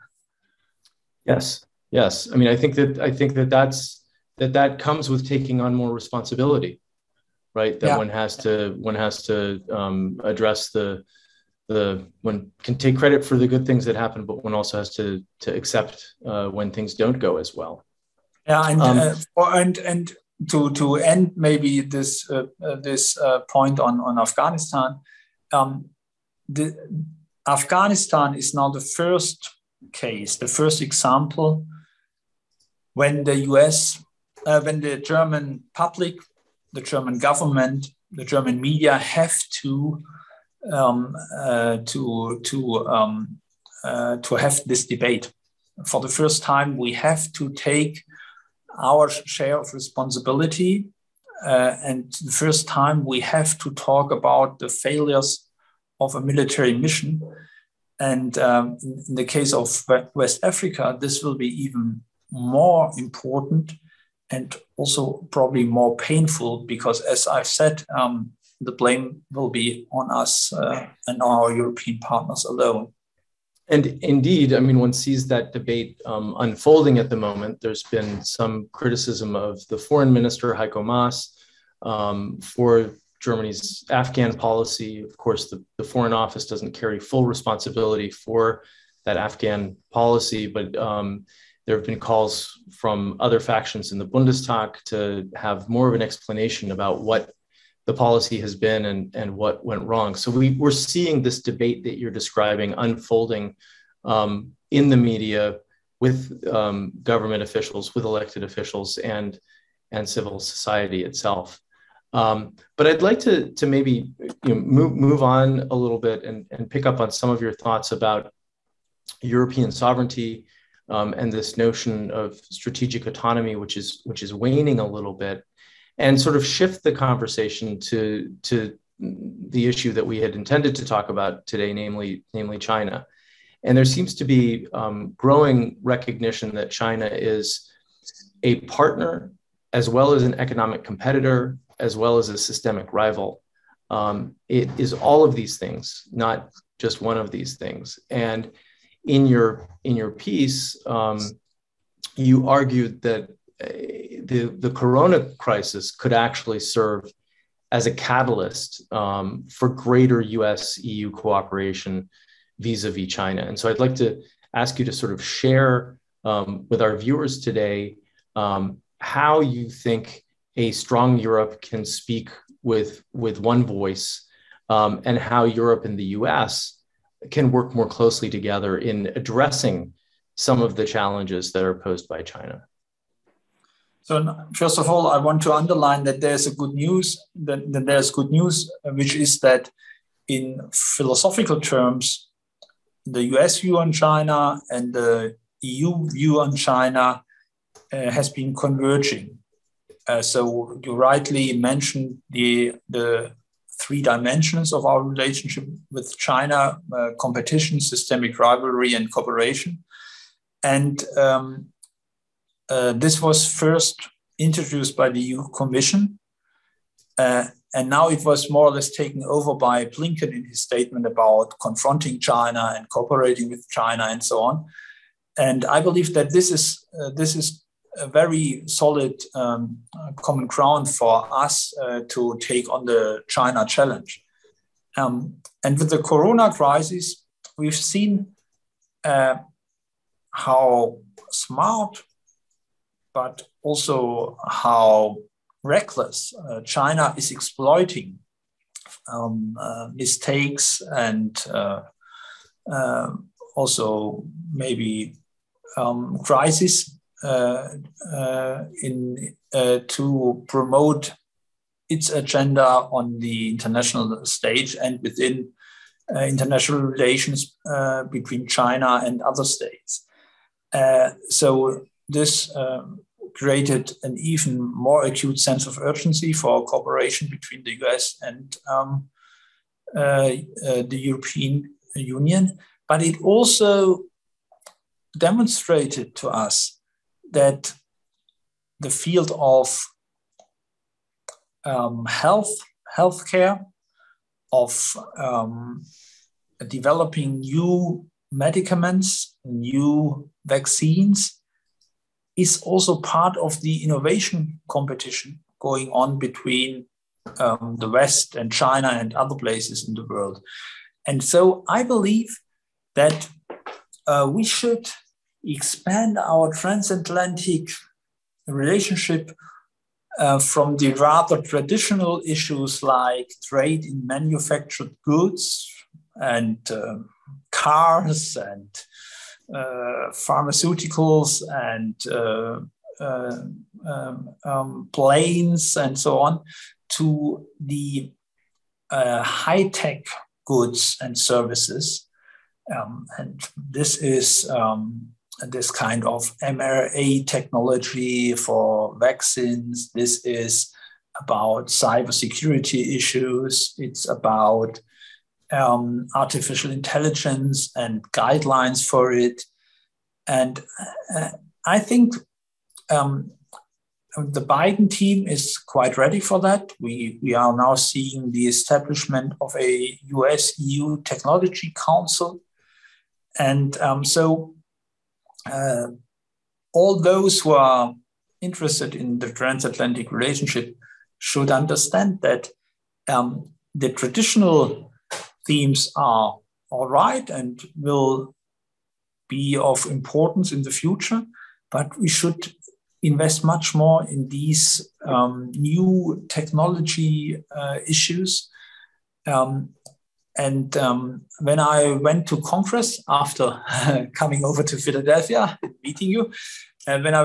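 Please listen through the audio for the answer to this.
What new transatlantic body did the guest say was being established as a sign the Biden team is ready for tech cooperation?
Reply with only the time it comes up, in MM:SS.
06:10.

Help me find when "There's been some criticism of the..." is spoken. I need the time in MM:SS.
01:17.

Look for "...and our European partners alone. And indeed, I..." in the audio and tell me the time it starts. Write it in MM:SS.
01:11.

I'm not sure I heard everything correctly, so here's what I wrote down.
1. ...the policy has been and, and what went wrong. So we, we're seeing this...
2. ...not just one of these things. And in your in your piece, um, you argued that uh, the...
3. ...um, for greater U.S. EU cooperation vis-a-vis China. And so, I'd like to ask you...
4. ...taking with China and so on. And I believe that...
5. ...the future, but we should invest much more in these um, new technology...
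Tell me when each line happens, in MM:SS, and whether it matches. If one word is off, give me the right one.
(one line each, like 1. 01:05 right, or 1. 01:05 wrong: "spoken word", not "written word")
1. 01:37 right
2. 02:26 right
3. 02:38 right
4. 03:42 wrong: "cooperating", not "taking"
5. 06:30 right.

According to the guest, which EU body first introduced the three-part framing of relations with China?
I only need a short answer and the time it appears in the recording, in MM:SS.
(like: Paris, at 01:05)
EU Commission, at 03:35.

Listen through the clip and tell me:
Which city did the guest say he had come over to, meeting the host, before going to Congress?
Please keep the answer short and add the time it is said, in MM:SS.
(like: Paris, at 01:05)
Philadelphia, at 06:44.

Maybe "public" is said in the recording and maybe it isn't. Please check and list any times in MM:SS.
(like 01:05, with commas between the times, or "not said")
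00:35.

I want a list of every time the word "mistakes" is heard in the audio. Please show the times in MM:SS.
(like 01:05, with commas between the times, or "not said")
04:09.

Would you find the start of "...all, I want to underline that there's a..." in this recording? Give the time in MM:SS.
03:04.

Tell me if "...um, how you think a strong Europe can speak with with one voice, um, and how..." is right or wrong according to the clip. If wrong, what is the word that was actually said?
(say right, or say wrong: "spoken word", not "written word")
right.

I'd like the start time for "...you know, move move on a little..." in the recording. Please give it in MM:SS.
01:54.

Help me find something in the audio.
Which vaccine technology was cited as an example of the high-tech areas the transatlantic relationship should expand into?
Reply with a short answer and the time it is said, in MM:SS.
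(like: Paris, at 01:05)
mRNA technology, at 05:46.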